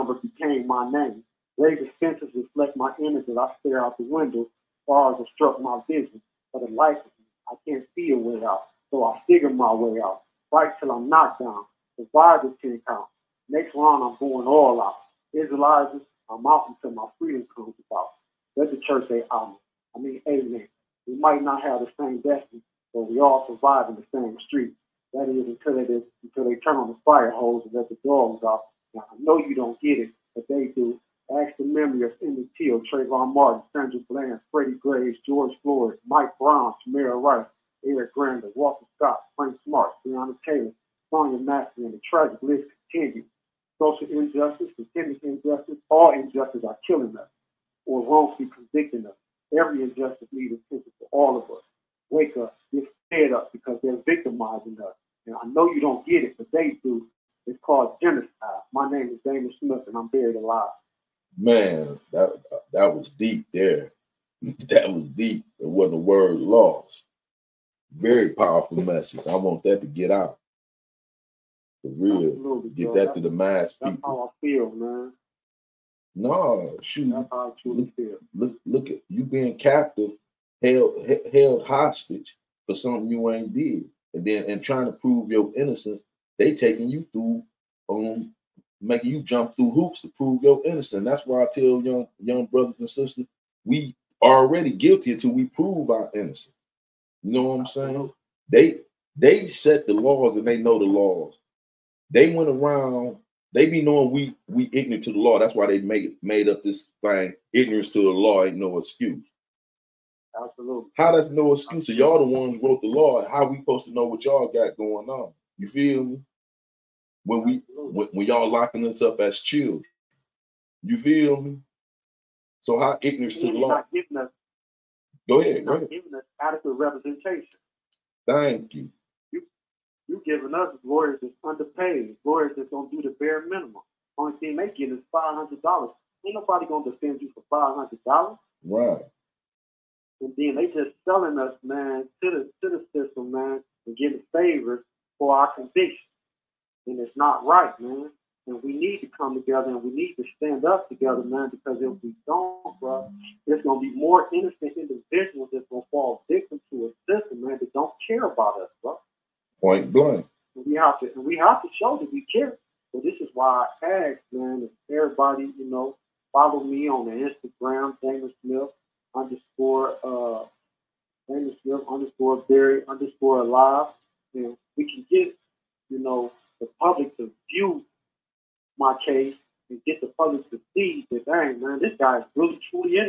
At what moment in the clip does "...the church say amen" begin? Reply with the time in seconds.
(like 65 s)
18 s.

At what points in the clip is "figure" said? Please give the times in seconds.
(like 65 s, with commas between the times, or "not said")
9 s.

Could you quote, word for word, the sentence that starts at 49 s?
Every injustice needs attention for all of us.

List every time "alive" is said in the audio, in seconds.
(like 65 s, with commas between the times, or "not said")
60 s, 173 s.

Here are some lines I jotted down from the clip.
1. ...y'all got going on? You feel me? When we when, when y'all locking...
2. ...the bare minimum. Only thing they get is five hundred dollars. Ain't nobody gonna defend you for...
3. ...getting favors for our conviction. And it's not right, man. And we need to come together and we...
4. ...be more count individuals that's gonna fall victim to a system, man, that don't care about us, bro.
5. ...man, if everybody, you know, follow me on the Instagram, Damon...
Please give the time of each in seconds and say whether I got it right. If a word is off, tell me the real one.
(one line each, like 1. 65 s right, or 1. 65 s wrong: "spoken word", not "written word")
1. 114 s right
2. 133 s right
3. 143 s right
4. 153 s wrong: "innocent", not "count"
5. 164 s right.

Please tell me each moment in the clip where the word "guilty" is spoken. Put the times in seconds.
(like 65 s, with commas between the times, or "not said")
94 s.